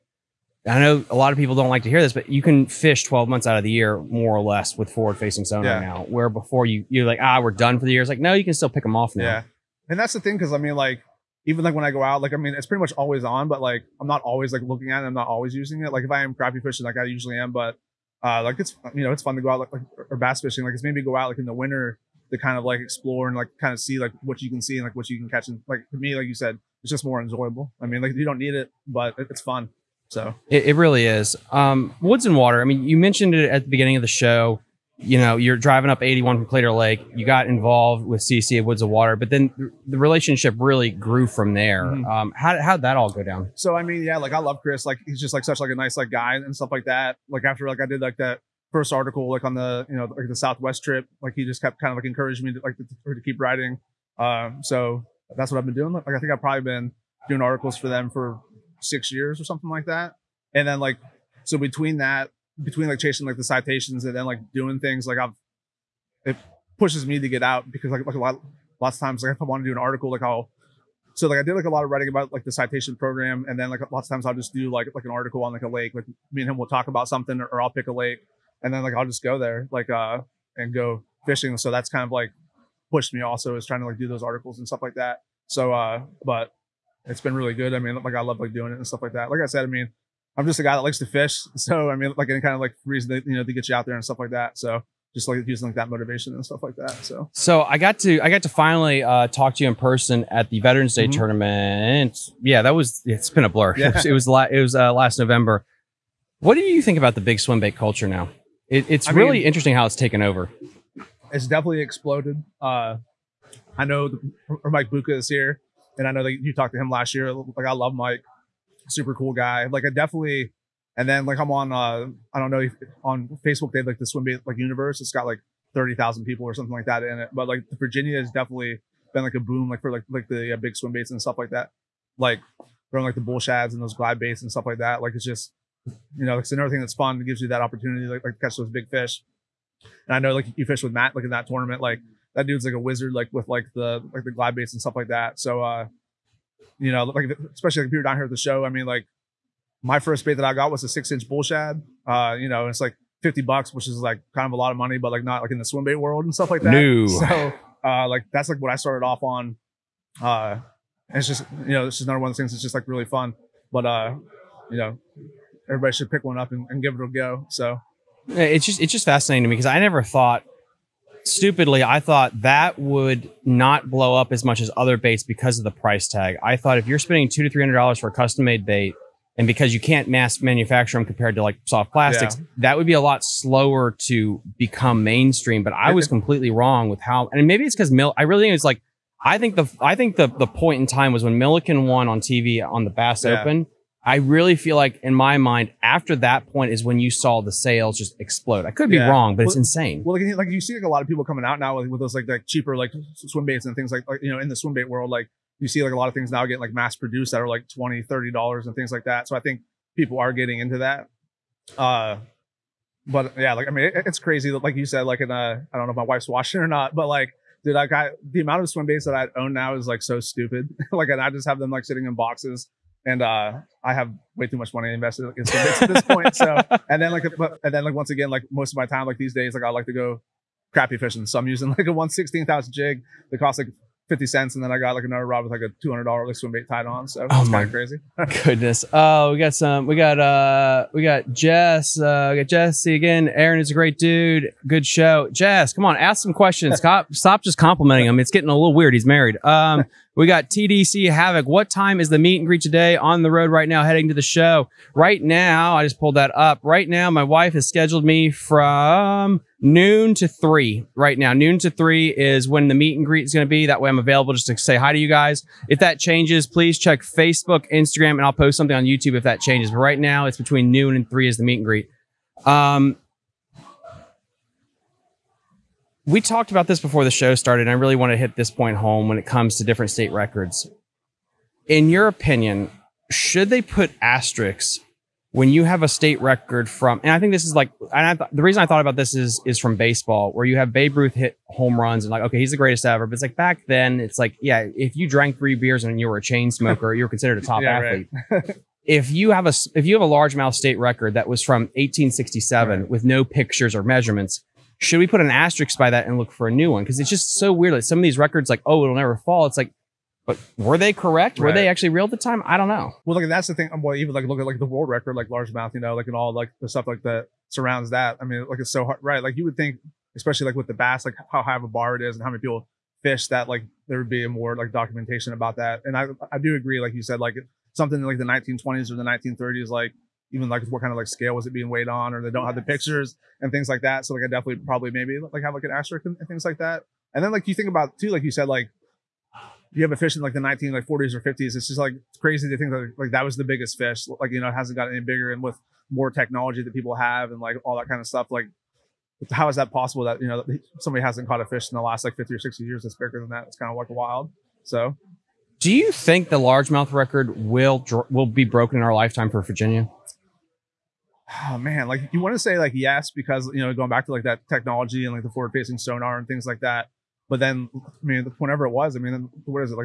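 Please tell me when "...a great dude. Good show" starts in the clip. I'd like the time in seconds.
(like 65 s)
243 s.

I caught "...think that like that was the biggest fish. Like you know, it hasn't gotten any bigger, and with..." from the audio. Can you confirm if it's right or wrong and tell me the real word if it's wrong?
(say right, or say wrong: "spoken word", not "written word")
right.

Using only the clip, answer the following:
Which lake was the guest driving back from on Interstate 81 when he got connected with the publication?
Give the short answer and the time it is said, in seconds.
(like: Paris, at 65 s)
Claytor Lake, at 36 s.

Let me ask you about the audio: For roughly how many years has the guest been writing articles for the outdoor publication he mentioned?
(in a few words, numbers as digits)
6 years.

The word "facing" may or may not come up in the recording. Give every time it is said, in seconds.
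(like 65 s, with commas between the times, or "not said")
5 s, 365 s.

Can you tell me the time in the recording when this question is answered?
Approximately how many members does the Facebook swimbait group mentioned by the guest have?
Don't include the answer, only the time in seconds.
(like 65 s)
125 s.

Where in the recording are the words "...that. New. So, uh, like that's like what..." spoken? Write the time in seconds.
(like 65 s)
156 s.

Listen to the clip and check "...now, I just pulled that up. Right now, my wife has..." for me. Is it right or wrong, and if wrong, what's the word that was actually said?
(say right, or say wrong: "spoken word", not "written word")
right.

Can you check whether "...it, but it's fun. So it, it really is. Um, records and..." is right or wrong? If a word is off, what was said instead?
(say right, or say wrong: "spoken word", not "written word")
wrong: "woods", not "records".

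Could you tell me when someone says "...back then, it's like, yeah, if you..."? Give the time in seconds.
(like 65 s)
293 s.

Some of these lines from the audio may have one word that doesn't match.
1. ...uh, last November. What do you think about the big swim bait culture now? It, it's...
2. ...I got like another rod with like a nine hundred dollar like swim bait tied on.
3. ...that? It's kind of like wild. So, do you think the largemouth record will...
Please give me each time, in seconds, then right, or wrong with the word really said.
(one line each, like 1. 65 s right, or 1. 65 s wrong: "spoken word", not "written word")
1. 104 s right
2. 234 s wrong: "two", not "nine"
3. 353 s right.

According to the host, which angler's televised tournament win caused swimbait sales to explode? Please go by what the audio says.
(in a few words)
Milliken.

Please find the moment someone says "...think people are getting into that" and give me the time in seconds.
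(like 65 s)
209 s.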